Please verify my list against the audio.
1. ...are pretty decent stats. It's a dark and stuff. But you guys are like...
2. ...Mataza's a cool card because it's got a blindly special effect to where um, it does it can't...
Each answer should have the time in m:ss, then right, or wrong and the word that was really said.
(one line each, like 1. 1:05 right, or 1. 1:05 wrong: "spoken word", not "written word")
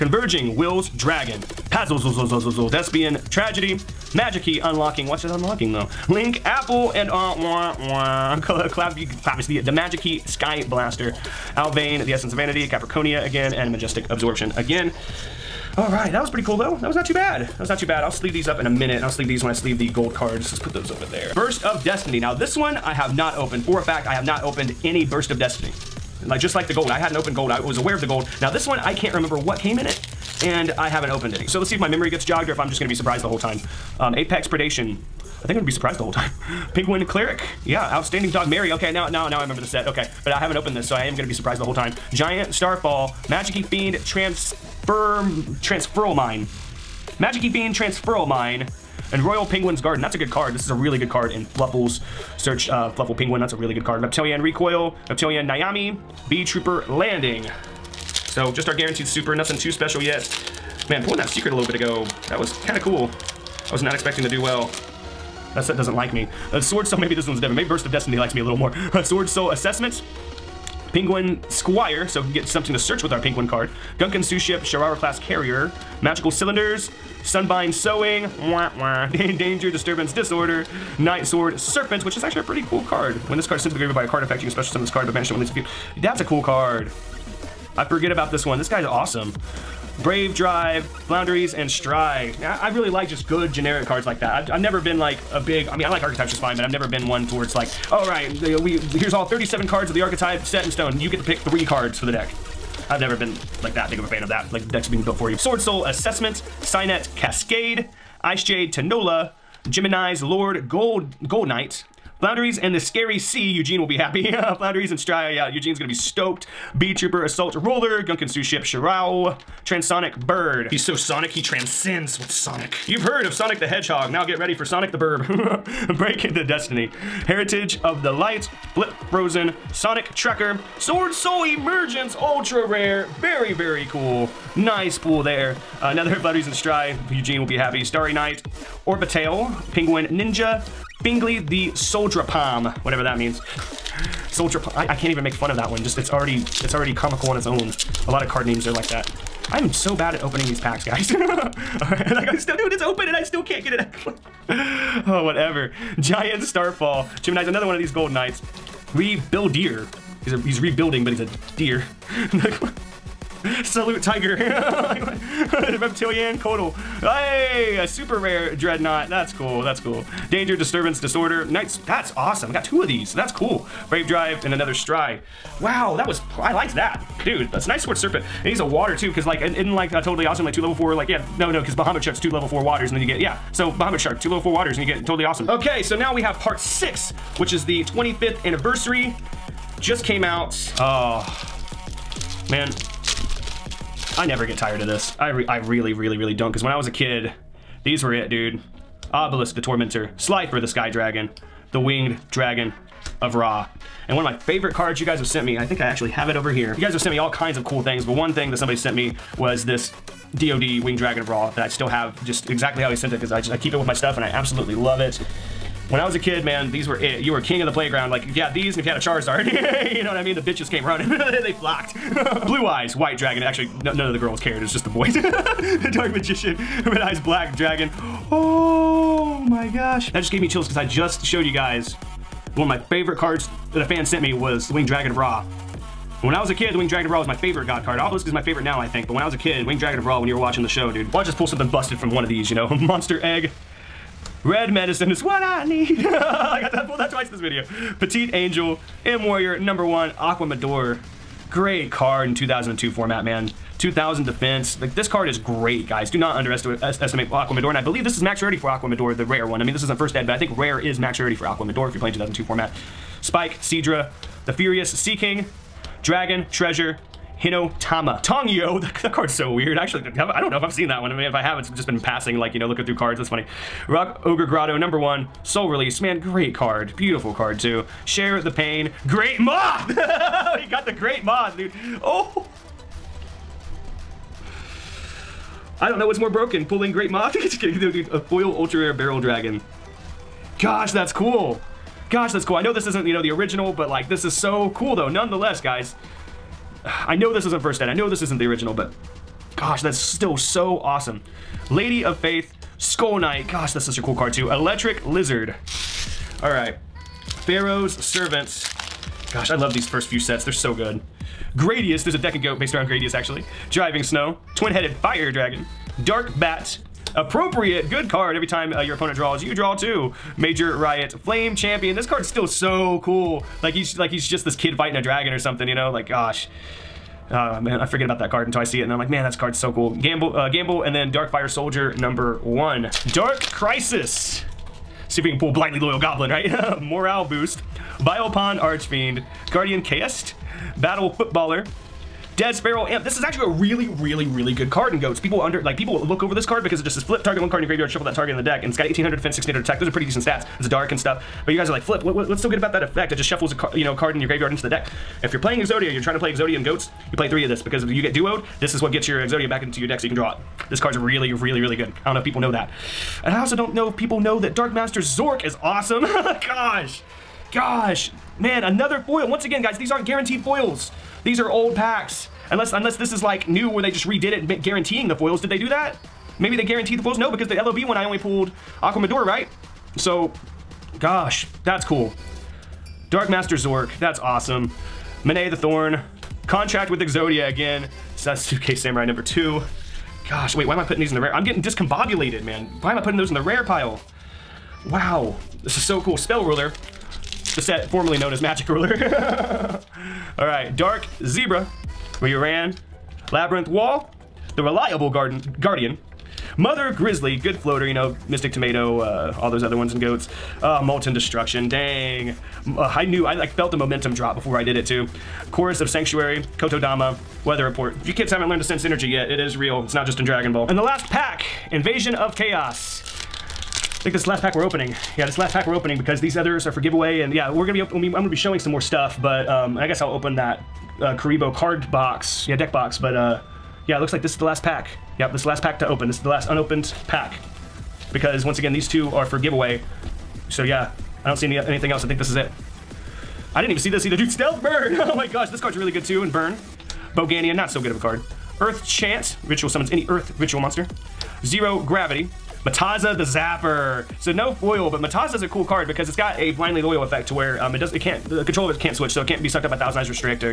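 1. 5:49 right
2. 7:35 wrong: "loyal", not "special".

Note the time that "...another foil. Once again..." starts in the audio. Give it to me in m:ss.
6:08.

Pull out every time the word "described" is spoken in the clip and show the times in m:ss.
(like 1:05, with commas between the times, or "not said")
not said.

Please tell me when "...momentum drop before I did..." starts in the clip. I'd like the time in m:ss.
6:53.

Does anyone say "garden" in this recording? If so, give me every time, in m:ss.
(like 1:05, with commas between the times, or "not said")
0:49, 6:45.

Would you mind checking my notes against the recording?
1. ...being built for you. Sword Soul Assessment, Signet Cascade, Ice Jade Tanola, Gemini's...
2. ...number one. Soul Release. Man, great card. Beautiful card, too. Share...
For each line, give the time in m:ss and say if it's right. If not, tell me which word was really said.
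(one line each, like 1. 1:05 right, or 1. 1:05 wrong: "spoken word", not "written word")
1. 1:44 right
2. 4:34 right.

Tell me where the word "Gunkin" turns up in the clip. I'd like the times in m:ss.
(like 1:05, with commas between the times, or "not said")
1:13, 1:58.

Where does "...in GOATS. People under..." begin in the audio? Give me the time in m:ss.
5:44.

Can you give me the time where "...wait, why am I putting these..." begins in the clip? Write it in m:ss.
6:30.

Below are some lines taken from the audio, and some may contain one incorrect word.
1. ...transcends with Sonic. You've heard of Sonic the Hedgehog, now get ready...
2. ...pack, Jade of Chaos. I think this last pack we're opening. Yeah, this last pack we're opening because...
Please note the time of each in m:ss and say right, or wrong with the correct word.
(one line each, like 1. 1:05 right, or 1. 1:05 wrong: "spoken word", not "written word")
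1. 2:01 right
2. 7:01 wrong: "Invasion", not "Jade".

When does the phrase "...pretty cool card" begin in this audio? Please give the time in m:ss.
1:22.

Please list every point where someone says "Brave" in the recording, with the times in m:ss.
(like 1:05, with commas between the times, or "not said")
1:30, 2:53.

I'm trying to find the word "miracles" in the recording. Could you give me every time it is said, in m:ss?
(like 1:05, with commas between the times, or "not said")
not said.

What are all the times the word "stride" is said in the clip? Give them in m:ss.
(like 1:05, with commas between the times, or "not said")
1:31, 2:16, 2:54.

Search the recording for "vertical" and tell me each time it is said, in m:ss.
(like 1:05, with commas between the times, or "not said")
not said.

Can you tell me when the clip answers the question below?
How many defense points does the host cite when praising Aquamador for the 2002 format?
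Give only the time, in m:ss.
4:13.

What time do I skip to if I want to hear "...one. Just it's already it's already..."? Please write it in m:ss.
2:25.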